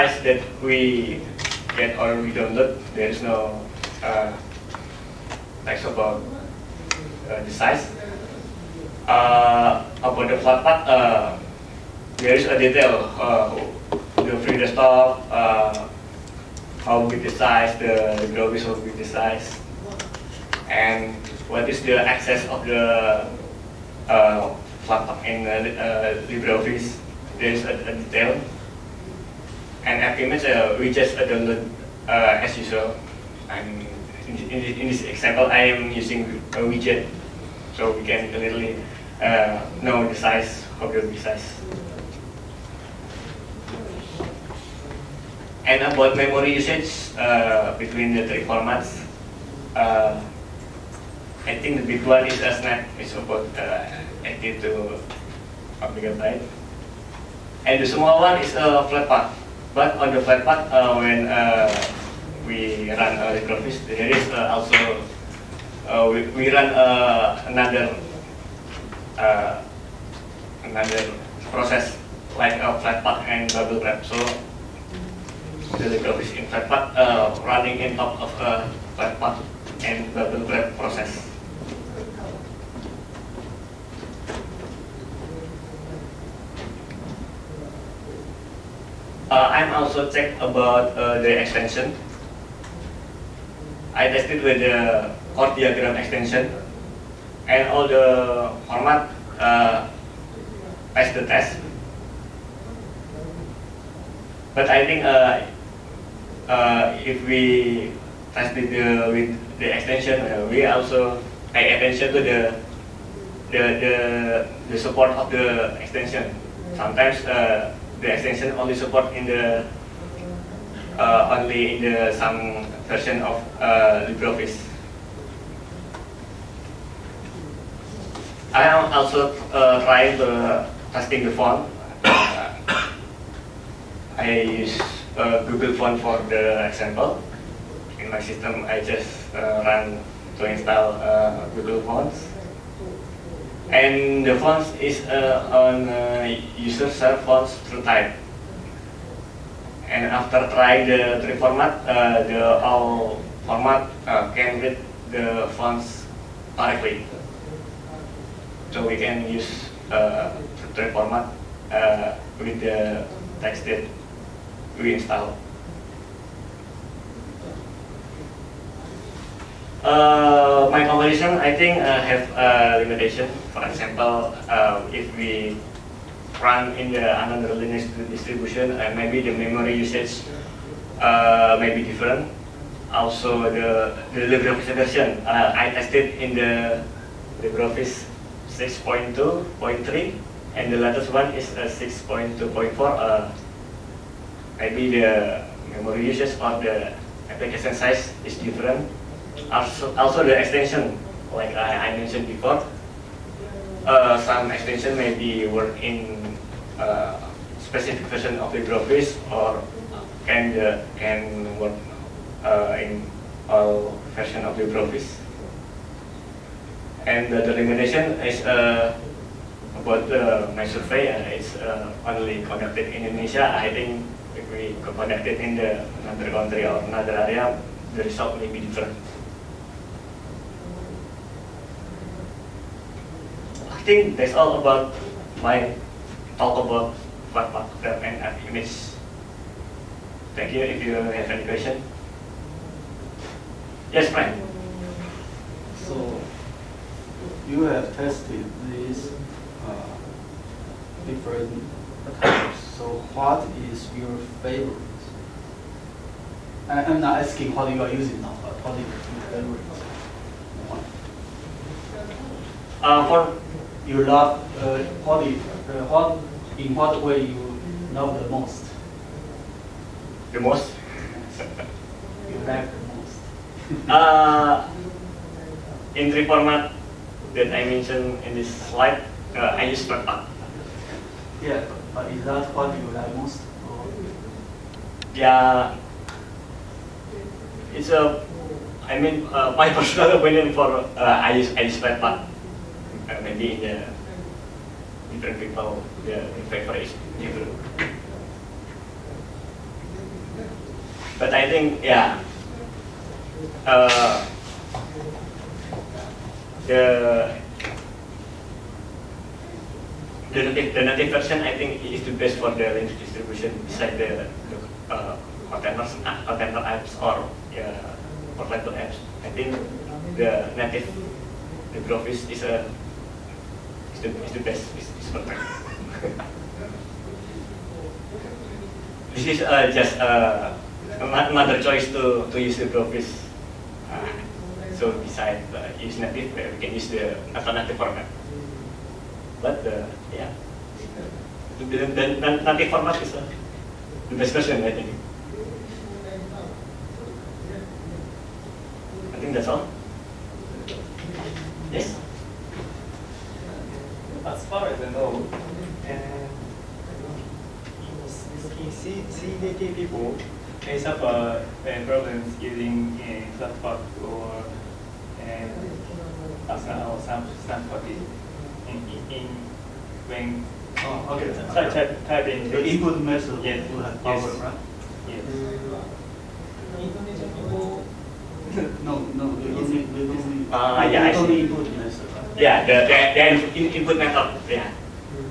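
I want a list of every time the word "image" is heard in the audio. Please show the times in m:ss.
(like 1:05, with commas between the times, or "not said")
0:30, 3:58.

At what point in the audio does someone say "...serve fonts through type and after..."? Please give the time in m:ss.
2:26.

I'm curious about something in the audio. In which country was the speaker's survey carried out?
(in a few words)
Indonesia.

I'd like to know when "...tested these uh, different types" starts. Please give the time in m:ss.
4:07.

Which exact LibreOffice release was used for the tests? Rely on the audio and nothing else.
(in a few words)
6.2.3.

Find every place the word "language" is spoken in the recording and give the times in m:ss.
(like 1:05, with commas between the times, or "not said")
5:12.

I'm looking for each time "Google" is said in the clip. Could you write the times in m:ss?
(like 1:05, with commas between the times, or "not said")
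2:15, 2:21.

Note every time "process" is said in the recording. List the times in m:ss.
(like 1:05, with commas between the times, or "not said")
1:11, 1:20.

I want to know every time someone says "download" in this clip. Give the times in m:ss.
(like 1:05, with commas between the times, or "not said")
0:02, 0:31.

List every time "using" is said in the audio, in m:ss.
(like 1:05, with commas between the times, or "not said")
0:35, 4:17, 6:02.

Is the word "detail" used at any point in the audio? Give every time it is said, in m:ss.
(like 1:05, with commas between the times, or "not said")
0:12, 0:27.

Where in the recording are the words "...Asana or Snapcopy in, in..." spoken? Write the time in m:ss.
6:06.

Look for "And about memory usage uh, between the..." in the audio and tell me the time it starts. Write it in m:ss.
0:45.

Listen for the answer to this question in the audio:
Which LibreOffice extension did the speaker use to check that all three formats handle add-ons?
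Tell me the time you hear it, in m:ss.
1:35.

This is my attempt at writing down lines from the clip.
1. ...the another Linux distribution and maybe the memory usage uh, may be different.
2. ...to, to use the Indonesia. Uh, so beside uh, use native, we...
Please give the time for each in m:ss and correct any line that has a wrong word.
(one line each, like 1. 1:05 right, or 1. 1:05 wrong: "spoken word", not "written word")
1. 2:56 right
2. 5:31 wrong: "Brofist", not "Indonesia".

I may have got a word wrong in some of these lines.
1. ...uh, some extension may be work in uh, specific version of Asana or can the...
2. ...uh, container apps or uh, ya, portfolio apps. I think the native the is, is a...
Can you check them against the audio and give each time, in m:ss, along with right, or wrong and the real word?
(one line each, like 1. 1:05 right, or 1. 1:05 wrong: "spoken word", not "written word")
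1. 3:23 wrong: "LibreOffice", not "Asana"
2. 5:16 right.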